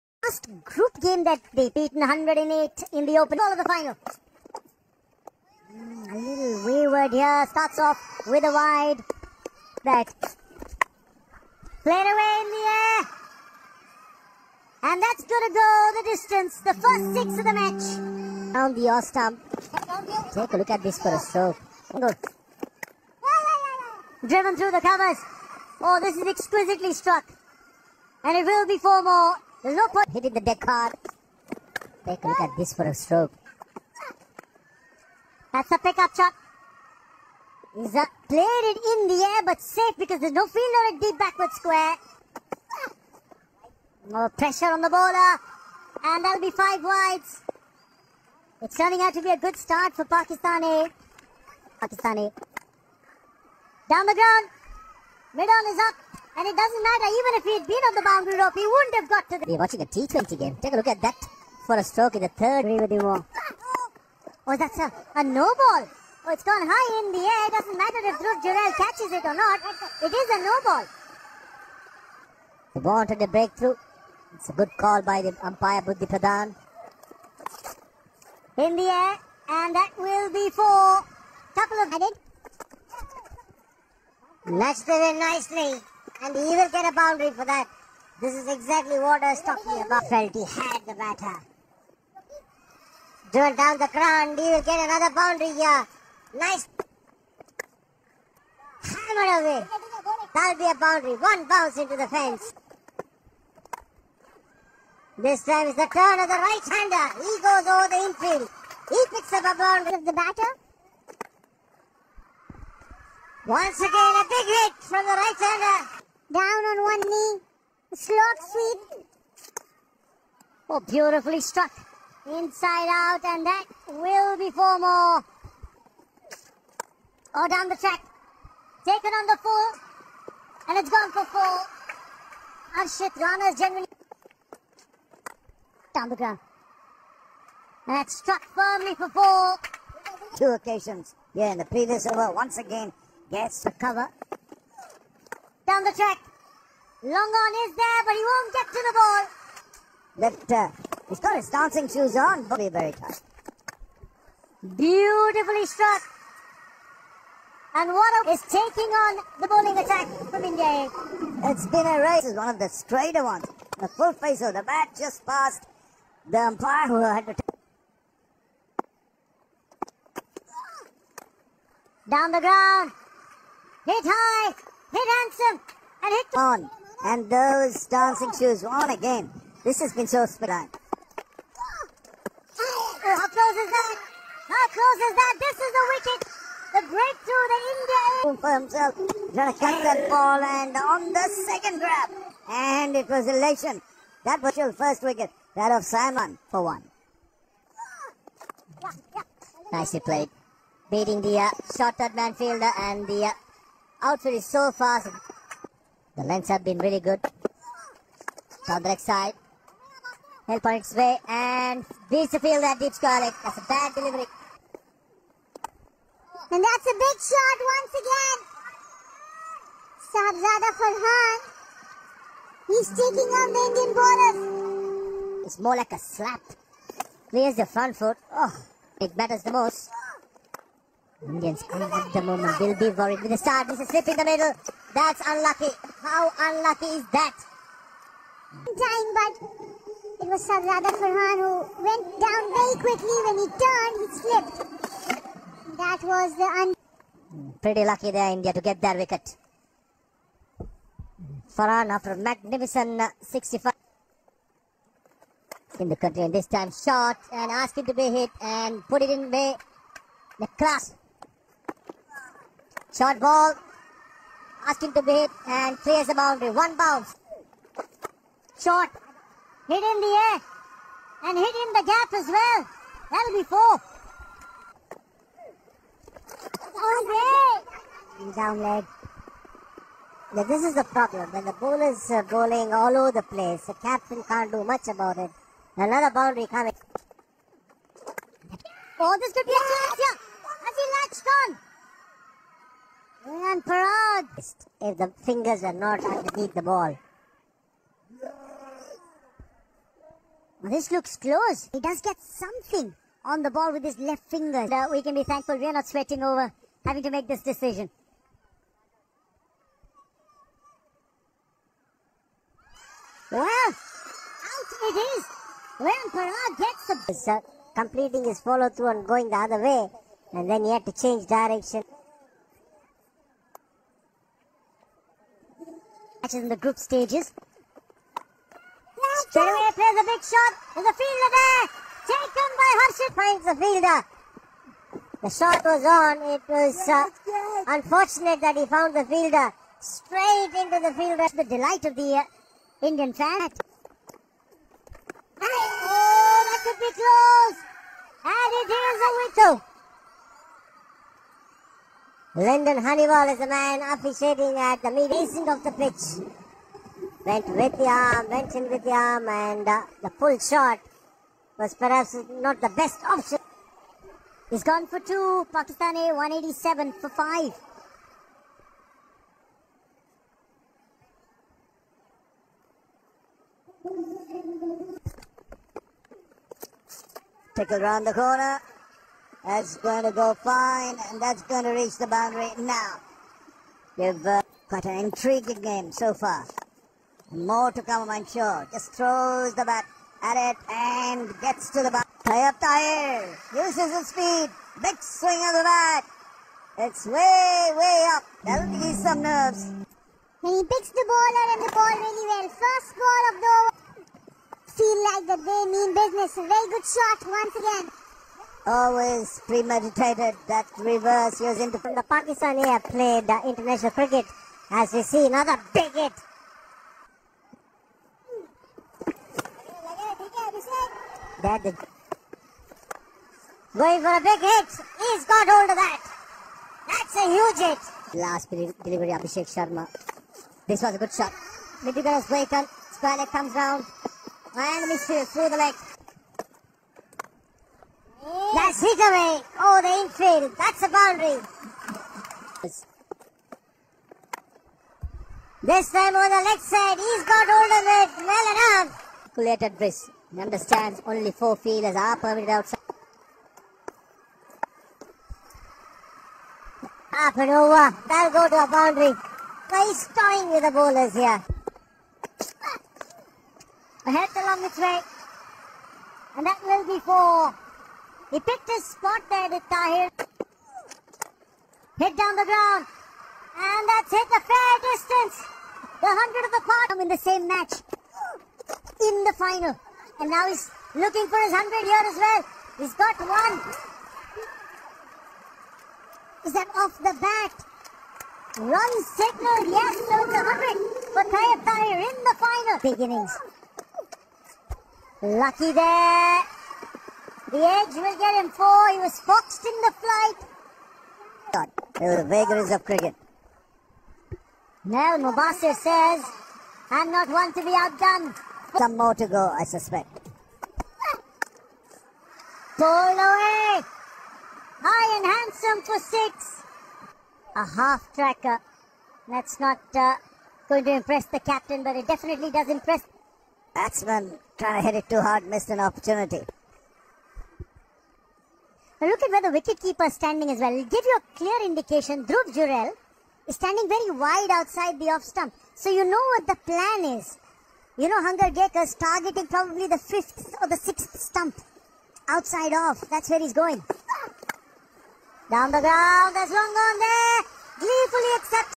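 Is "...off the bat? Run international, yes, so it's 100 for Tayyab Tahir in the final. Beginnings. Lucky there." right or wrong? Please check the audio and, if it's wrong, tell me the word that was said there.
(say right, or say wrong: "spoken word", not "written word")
wrong: "signal", not "international".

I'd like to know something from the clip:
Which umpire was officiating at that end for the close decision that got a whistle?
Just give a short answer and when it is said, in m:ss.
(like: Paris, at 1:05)
Lyndon Hannibal, at 5:52.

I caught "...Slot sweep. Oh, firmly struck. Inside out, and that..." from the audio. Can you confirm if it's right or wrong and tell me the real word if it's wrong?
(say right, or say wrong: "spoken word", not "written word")
wrong: "beautifully", not "firmly".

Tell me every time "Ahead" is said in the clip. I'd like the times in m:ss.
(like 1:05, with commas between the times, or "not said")
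7:44.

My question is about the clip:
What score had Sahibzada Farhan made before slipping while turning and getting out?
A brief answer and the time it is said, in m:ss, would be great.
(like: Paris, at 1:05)
65, at 4:13.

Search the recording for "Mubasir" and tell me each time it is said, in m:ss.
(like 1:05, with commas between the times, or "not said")
8:25.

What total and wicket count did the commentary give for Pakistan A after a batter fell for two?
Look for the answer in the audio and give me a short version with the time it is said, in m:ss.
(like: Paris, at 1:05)
187 for 5, at 6:06.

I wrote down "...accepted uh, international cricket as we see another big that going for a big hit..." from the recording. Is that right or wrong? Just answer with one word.
wrong.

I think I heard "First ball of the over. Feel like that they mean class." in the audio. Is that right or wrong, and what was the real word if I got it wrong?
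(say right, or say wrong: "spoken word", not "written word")
wrong: "business", not "class".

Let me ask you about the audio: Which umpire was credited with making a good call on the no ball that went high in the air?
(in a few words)
Buddhi Pradhan.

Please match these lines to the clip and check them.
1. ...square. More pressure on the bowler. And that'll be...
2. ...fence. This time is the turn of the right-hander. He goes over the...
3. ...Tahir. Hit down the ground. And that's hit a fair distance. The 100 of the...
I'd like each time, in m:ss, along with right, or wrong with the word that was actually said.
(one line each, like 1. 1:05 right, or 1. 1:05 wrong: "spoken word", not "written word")
1. 0:41 right
2. 1:42 right
3. 7:49 right.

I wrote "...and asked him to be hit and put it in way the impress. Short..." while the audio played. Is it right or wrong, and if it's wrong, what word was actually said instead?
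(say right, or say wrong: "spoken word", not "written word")
wrong: "class", not "impress".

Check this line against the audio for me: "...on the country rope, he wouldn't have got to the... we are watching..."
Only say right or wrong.
wrong.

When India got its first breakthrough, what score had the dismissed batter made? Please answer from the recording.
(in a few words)
1.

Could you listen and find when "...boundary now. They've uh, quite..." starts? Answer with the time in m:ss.
6:22.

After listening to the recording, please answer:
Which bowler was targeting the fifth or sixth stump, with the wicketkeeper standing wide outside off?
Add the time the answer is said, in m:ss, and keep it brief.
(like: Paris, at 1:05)
Hangargekar, at 8:58.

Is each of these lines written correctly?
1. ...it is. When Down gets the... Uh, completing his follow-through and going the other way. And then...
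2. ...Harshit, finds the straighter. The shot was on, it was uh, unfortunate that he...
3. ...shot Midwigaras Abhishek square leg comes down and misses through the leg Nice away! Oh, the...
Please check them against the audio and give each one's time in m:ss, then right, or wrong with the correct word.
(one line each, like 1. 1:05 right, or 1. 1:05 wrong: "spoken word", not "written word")
1. 5:14 wrong: "Parag", not "Down"
2. 5:32 wrong: "fielder", not "straighter"
3. 7:11 wrong: "Blakon", not "Abhishek".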